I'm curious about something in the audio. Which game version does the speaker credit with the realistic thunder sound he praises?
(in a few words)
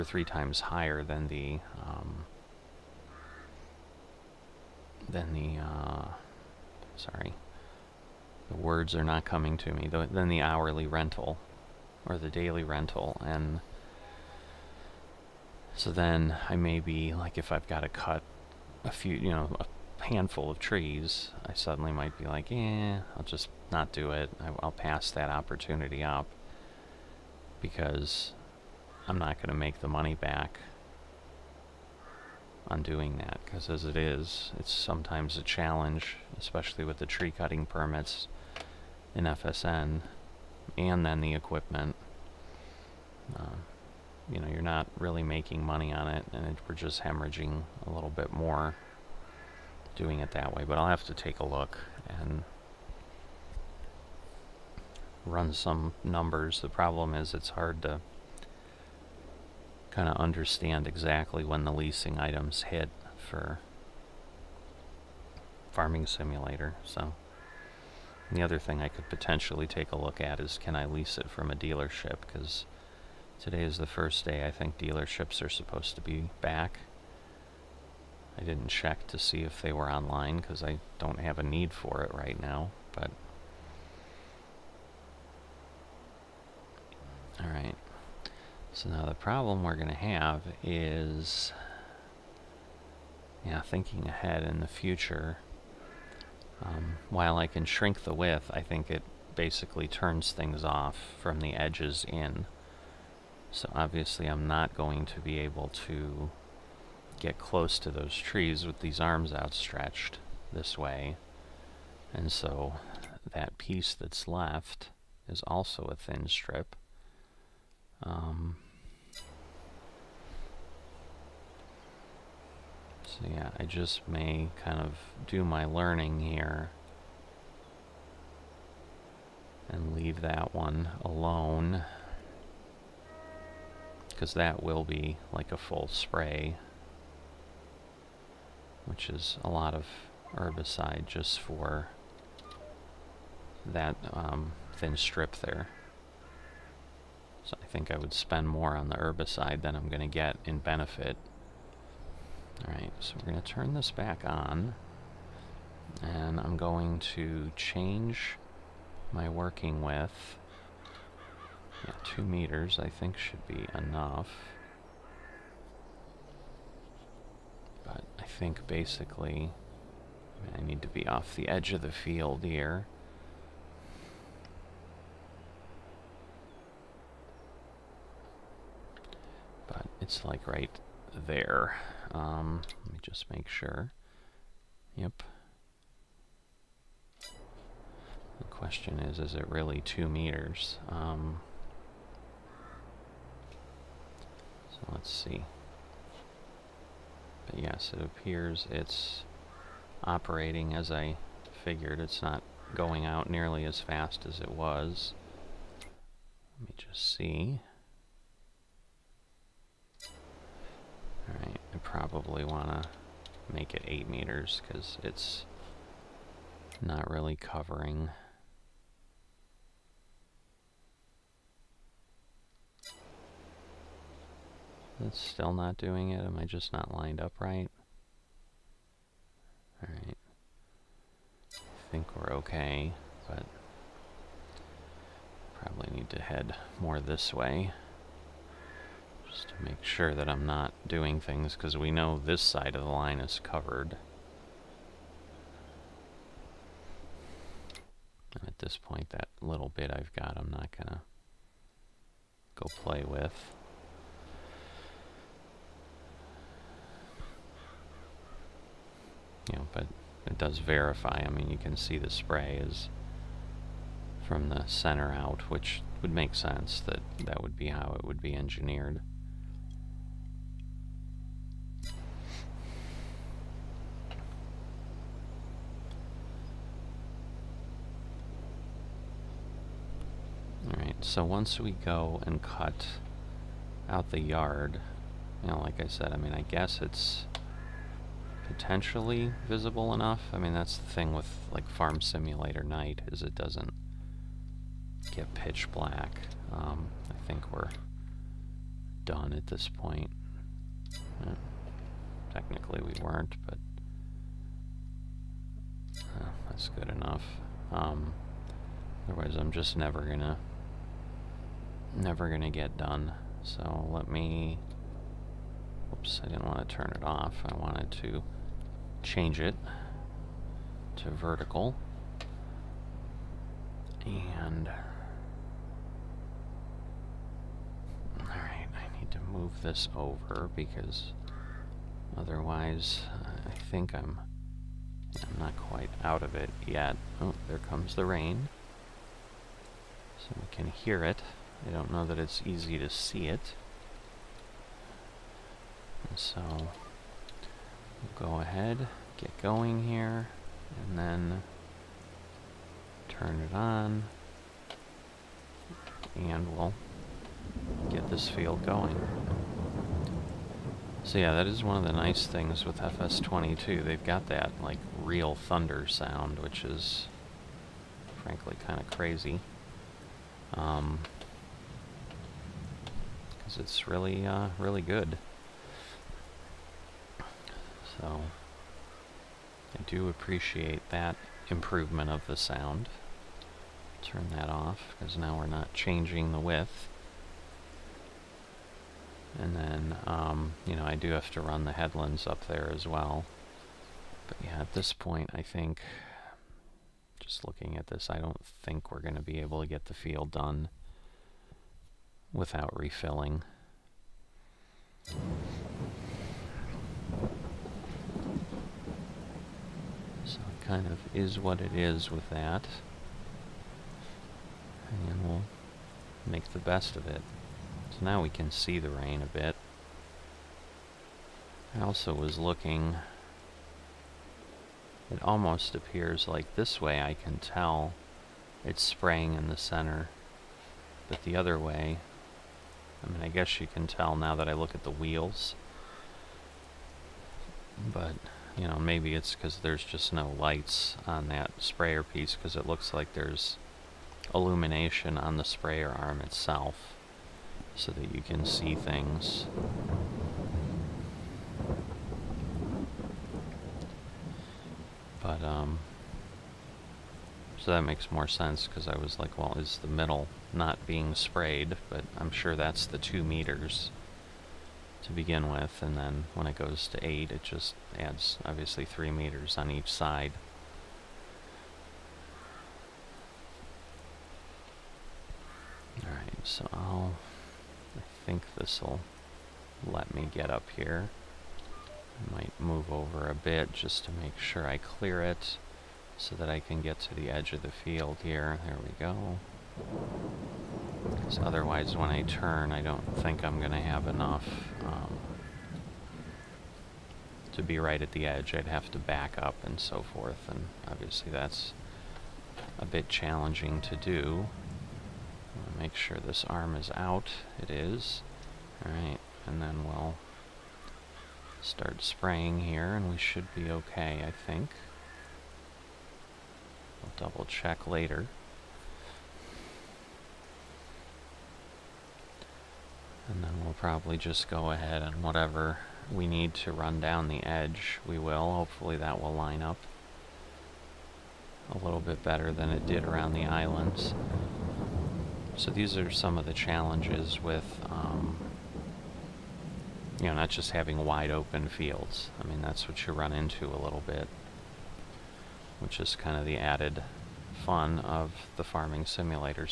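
FS22.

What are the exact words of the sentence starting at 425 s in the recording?
It almost appears like this way I can tell it's spraying in the center.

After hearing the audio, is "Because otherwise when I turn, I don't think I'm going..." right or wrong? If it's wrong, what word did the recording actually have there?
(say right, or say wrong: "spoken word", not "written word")
right.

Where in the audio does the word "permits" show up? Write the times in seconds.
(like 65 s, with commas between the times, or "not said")
37 s.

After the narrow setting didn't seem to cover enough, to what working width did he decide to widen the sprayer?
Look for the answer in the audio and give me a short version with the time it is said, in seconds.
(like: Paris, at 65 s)
8 meters, at 213 s.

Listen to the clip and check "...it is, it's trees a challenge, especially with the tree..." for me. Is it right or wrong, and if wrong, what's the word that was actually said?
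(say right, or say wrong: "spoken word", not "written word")
wrong: "sometimes", not "trees".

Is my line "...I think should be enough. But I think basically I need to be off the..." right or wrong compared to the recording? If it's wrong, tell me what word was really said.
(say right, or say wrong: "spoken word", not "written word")
right.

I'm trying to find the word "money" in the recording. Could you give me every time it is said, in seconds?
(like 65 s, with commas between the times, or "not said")
29 s, 45 s.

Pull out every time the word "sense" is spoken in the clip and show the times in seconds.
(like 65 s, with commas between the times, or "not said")
266 s, 458 s.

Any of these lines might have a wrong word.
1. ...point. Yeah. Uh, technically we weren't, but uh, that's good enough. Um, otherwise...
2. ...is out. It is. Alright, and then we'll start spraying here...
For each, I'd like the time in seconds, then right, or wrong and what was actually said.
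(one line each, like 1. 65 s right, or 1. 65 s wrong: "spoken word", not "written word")
1. 299 s right
2. 506 s right.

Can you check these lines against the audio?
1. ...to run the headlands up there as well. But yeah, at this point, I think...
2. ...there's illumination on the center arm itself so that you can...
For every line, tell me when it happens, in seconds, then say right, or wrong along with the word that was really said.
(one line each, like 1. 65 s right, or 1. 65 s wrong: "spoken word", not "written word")
1. 391 s right
2. 443 s wrong: "sprayer", not "center".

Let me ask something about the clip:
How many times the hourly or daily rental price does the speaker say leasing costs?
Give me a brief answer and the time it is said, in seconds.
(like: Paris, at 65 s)
3, at 0 s.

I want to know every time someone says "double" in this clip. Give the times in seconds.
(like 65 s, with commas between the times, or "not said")
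517 s.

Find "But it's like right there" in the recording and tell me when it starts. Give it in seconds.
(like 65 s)
179 s.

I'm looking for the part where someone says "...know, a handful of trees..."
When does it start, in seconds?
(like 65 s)
19 s.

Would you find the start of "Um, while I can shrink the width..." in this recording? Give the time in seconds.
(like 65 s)
96 s.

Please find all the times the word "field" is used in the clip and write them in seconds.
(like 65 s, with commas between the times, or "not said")
171 s, 358 s, 399 s, 487 s, 541 s.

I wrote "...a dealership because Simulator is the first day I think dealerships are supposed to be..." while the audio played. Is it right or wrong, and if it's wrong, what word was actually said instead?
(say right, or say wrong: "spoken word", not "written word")
wrong: "Today", not "Simulator".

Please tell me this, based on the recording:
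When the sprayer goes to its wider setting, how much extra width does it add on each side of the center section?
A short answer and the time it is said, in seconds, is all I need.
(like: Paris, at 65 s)
3 meters, at 468 s.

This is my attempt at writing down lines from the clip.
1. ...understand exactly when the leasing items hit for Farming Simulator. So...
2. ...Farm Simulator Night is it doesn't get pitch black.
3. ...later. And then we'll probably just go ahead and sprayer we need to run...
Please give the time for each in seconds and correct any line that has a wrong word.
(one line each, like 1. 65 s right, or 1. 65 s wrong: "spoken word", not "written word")
1. 60 s right
2. 291 s right
3. 517 s wrong: "whatever", not "sprayer".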